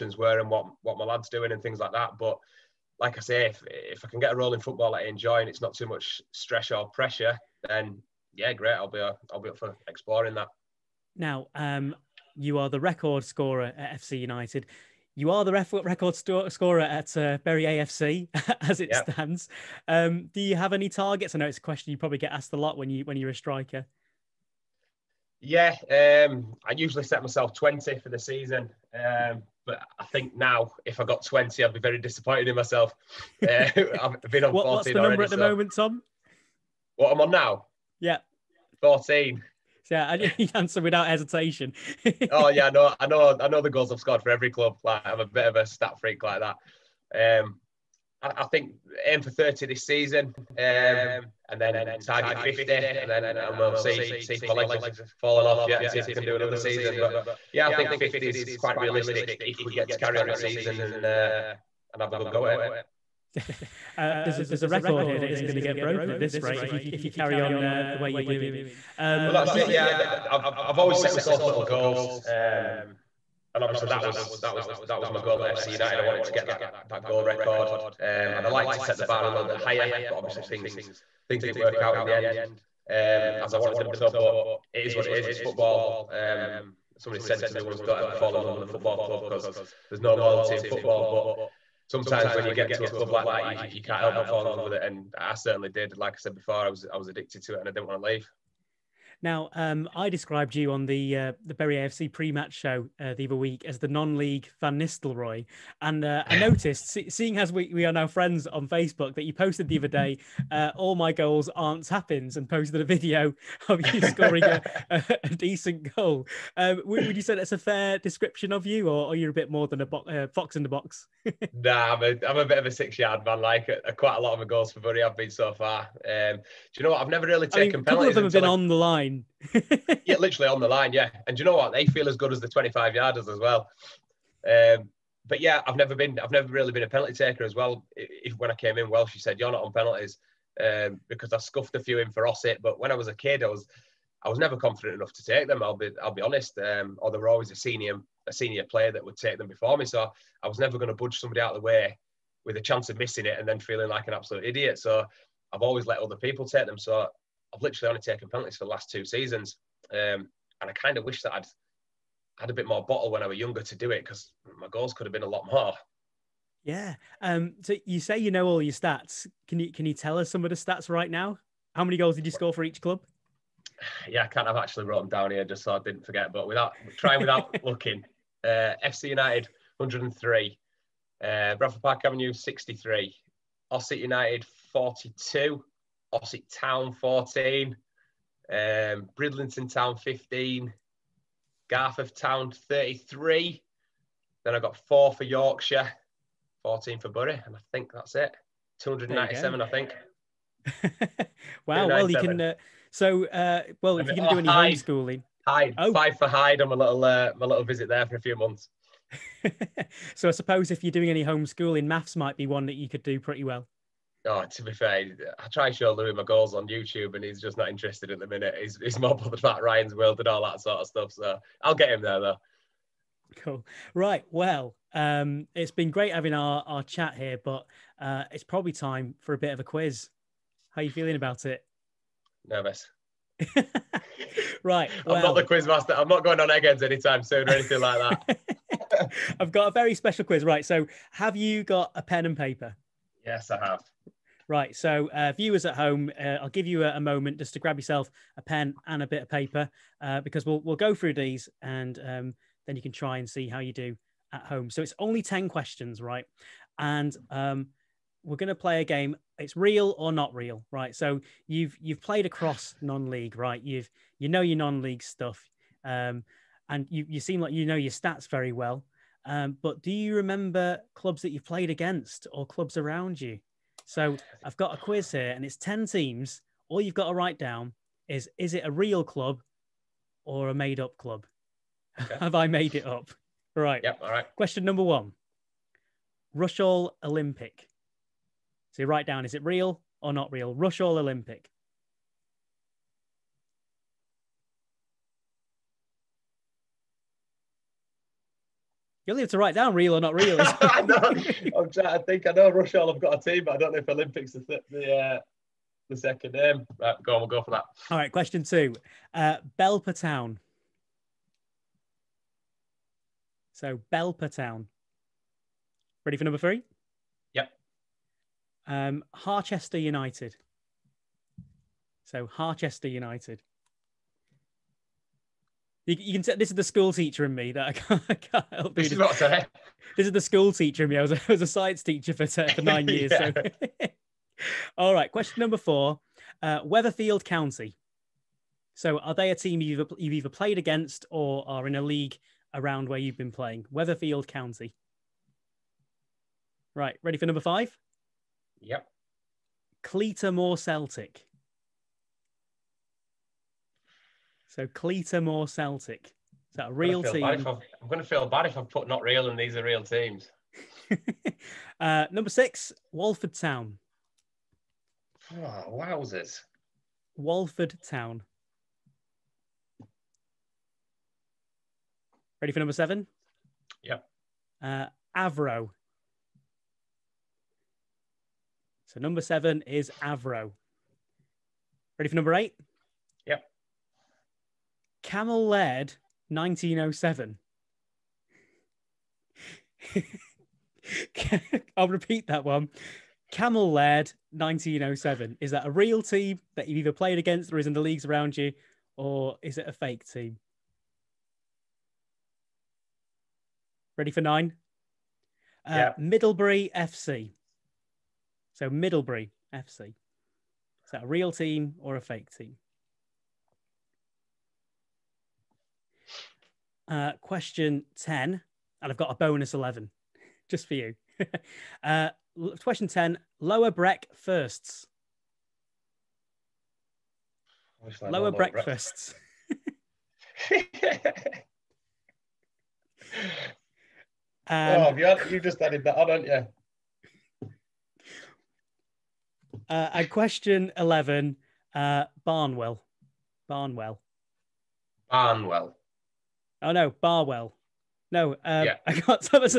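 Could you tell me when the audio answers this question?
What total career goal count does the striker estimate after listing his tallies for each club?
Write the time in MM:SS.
03:18.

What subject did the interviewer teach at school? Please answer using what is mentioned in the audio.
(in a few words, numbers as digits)
Science.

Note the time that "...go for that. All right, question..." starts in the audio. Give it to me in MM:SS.
05:07.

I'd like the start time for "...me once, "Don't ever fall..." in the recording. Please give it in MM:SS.
01:27.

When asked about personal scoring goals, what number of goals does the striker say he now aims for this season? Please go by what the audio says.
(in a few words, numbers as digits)
30.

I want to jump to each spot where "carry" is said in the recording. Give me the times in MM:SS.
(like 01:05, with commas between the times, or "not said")
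00:59, 01:07.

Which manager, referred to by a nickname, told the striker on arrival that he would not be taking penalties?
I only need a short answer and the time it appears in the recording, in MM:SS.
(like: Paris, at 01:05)
Welshy, at 02:18.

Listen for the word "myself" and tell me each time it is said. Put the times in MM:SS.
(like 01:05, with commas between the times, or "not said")
00:27, 00:32, 01:11.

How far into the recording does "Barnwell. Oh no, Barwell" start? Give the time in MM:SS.
07:25.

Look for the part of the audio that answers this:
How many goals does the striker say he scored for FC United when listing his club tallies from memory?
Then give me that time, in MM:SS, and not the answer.
02:58.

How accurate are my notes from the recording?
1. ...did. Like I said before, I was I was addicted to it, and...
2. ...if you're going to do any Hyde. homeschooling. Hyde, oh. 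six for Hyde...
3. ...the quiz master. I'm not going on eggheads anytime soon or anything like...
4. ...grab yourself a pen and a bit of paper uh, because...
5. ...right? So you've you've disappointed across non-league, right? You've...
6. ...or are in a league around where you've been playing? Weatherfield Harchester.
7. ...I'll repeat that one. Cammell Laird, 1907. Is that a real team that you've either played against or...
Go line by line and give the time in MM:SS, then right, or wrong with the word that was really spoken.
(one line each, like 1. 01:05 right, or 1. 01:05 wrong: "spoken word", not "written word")
1. 01:35 right
2. 03:23 wrong: "five", not "six"
3. 03:55 right
4. 04:07 right
5. 04:20 wrong: "played", not "disappointed"
6. 05:41 wrong: "County", not "Harchester"
7. 06:31 right.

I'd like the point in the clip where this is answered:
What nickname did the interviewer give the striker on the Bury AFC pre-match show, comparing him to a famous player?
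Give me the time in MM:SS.
01:43.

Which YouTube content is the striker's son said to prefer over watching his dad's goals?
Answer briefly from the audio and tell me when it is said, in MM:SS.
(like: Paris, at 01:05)
Ryan's World, at 03:39.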